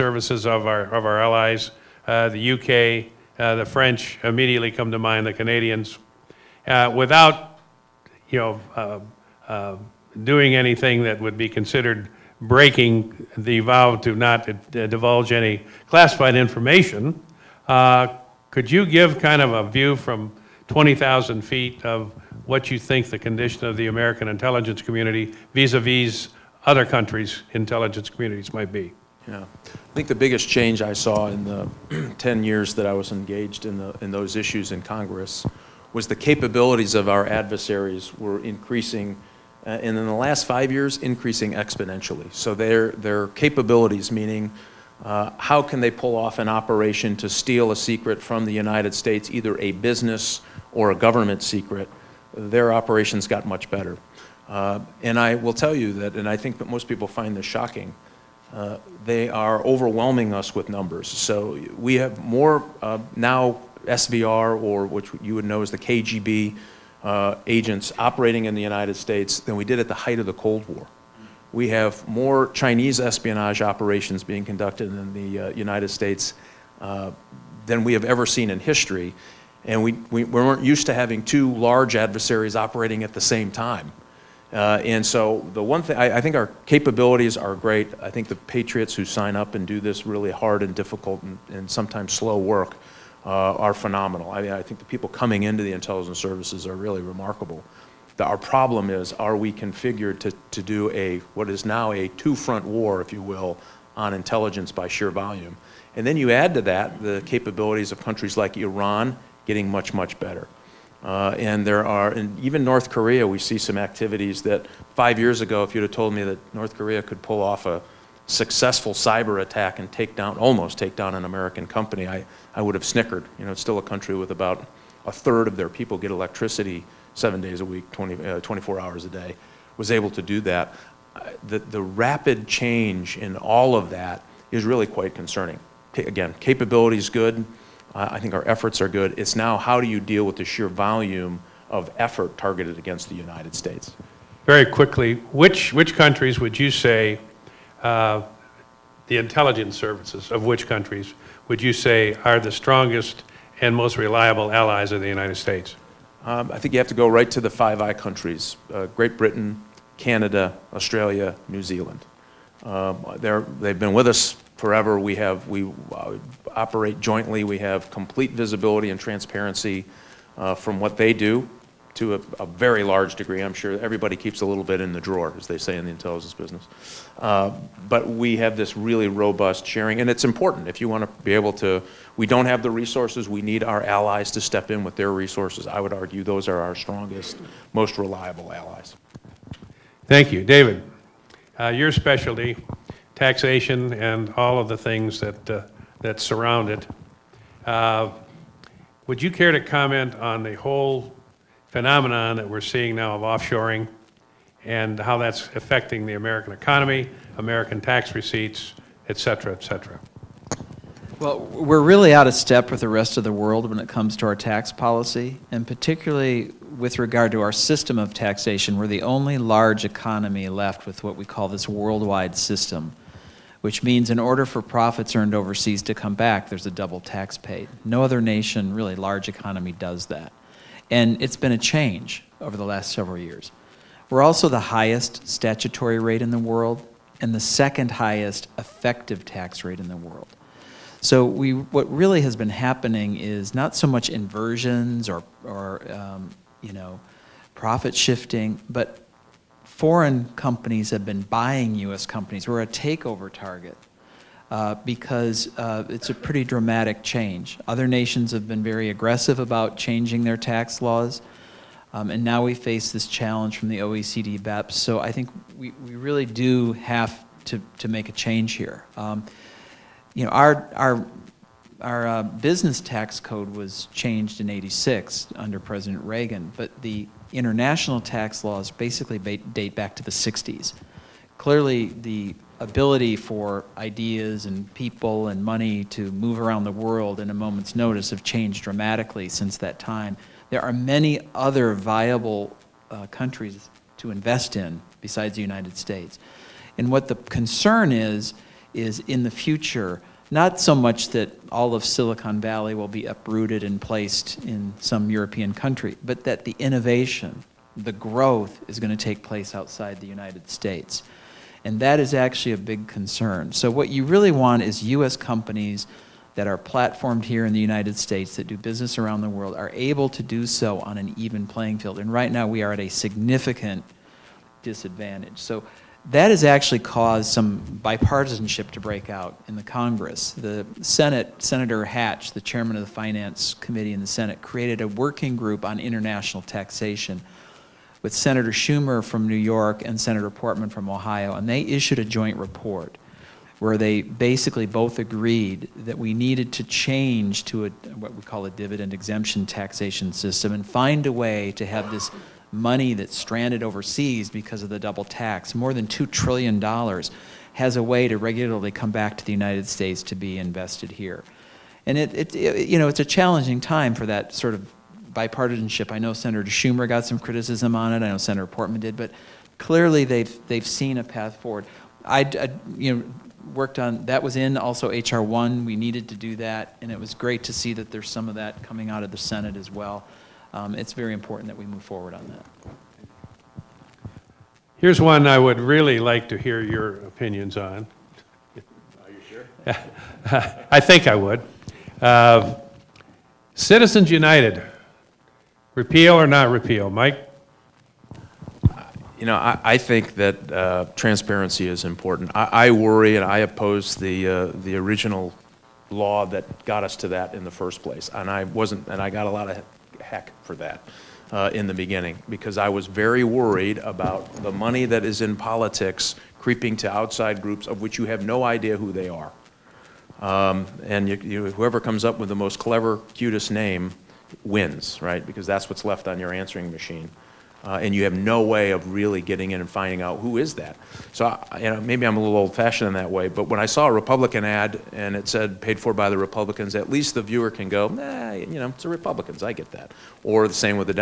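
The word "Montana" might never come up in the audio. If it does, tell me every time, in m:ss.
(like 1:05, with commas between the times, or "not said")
not said.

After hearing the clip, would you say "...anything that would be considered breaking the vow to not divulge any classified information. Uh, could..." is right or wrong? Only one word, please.
right.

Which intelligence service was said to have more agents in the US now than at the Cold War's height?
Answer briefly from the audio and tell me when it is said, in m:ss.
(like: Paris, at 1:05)
SVR, at 1:03.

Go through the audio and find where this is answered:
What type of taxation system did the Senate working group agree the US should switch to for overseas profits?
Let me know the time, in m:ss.
5:48.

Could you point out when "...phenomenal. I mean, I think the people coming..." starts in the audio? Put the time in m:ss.
1:33.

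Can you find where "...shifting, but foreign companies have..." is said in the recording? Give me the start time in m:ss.
4:07.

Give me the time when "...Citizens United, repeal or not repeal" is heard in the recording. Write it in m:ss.
6:33.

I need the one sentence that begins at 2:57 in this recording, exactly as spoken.
Uh, but we have this really robust sharing, and it's important if you want to be able to.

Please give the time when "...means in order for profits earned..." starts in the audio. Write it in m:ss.
3:43.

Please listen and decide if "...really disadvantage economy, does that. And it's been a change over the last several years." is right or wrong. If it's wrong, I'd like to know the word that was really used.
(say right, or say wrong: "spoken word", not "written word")
wrong: "large", not "disadvantage".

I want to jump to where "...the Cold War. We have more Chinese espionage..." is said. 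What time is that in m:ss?
1:10.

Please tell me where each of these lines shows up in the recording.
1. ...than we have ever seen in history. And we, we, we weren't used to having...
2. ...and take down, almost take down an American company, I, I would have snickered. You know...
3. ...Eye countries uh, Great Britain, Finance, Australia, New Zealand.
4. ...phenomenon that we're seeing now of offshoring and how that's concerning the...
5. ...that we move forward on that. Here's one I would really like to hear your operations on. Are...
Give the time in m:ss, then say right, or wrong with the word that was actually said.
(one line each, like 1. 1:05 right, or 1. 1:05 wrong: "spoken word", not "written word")
1. 1:17 right
2. 1:59 right
3. 2:37 wrong: "Canada", not "Finance"
4. 3:21 wrong: "affecting", not "concerning"
5. 6:21 wrong: "opinions", not "operations".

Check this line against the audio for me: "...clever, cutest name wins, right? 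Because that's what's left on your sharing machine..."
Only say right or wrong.
wrong.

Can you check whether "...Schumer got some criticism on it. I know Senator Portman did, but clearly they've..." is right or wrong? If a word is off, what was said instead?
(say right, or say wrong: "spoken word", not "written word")
right.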